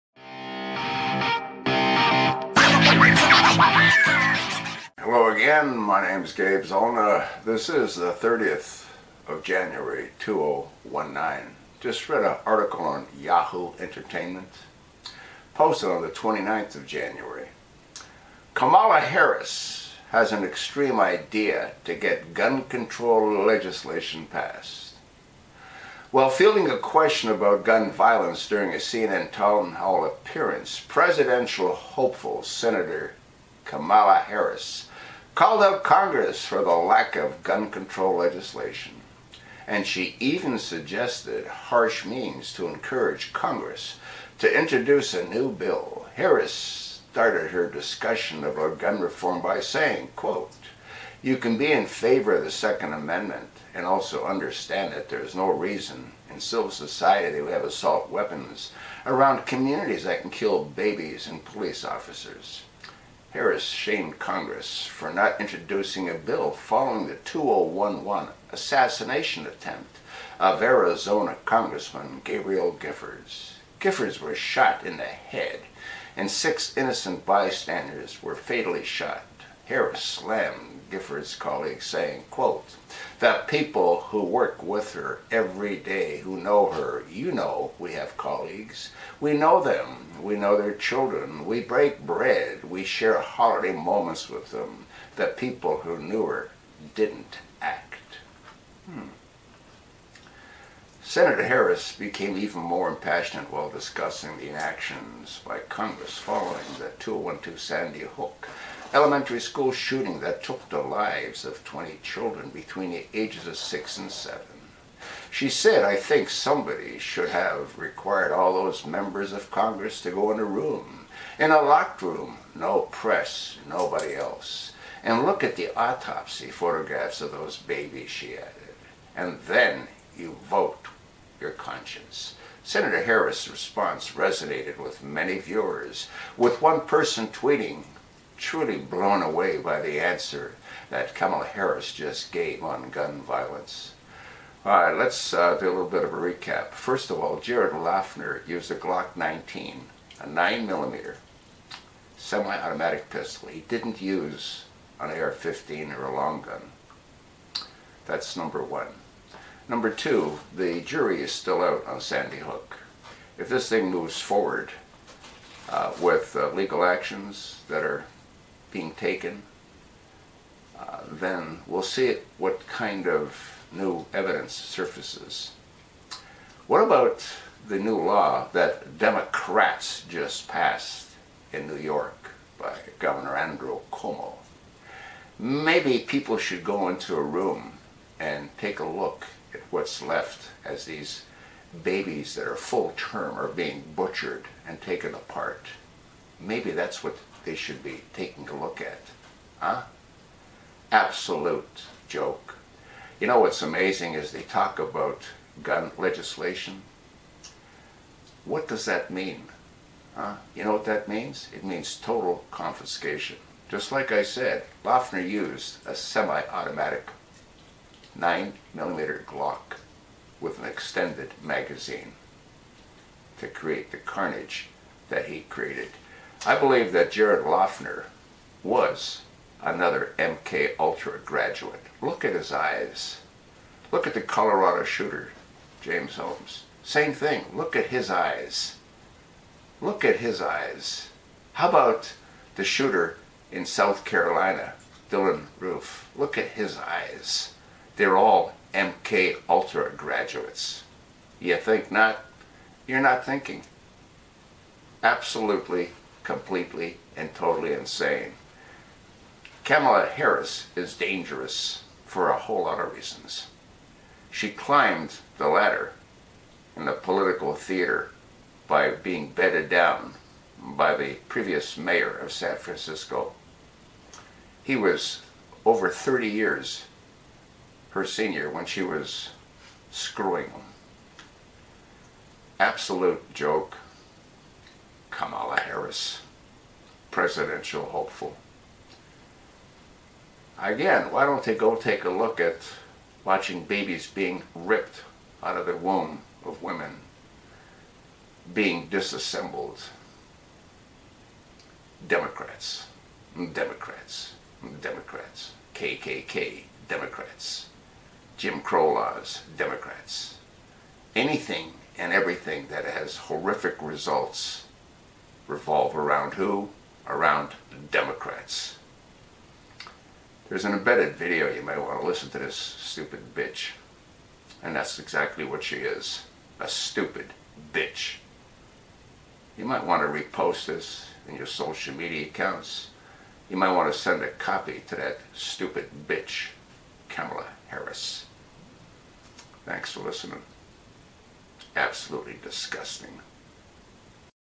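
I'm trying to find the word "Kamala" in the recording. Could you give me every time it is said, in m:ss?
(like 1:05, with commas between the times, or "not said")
0:18, 0:33, 2:21, 4:19, 4:45, 5:37.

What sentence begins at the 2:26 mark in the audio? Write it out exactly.
First of all, Jared Loughner used a Glock 19, a 9 millimeter semi-automatic pistol.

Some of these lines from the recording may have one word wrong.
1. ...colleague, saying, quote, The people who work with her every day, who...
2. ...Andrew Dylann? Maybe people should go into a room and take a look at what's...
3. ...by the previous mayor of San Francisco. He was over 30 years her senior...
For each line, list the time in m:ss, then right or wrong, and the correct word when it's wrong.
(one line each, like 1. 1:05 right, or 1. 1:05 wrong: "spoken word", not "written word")
1. 1:21 right
2. 3:03 wrong: "Cuomo", not "Dylann"
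3. 4:30 right.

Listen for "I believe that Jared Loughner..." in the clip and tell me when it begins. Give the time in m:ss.
3:46.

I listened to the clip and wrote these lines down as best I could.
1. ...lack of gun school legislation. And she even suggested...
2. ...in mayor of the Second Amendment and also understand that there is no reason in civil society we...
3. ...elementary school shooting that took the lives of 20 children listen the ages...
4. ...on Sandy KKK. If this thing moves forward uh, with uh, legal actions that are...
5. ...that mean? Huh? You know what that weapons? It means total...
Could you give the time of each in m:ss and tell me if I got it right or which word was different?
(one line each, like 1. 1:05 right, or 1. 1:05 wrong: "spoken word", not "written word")
1. 0:36 wrong: "control", not "school"
2. 0:51 wrong: "favor", not "mayor"
3. 1:48 wrong: "between", not "listen"
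4. 2:41 wrong: "Hook", not "KKK"
5. 3:28 wrong: "means", not "weapons".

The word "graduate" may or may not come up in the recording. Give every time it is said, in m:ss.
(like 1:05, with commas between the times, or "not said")
3:51, 4:09.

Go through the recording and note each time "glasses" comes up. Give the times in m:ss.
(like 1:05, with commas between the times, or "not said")
not said.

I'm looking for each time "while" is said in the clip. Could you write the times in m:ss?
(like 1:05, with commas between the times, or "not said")
0:26, 1:43.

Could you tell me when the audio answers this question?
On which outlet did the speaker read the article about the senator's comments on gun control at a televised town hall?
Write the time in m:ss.
0:13.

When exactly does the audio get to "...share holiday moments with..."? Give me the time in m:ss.
1:32.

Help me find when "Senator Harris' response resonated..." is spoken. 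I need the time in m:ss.
2:12.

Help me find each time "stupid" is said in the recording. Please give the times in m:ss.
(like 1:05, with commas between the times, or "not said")
5:22, 5:26, 5:35.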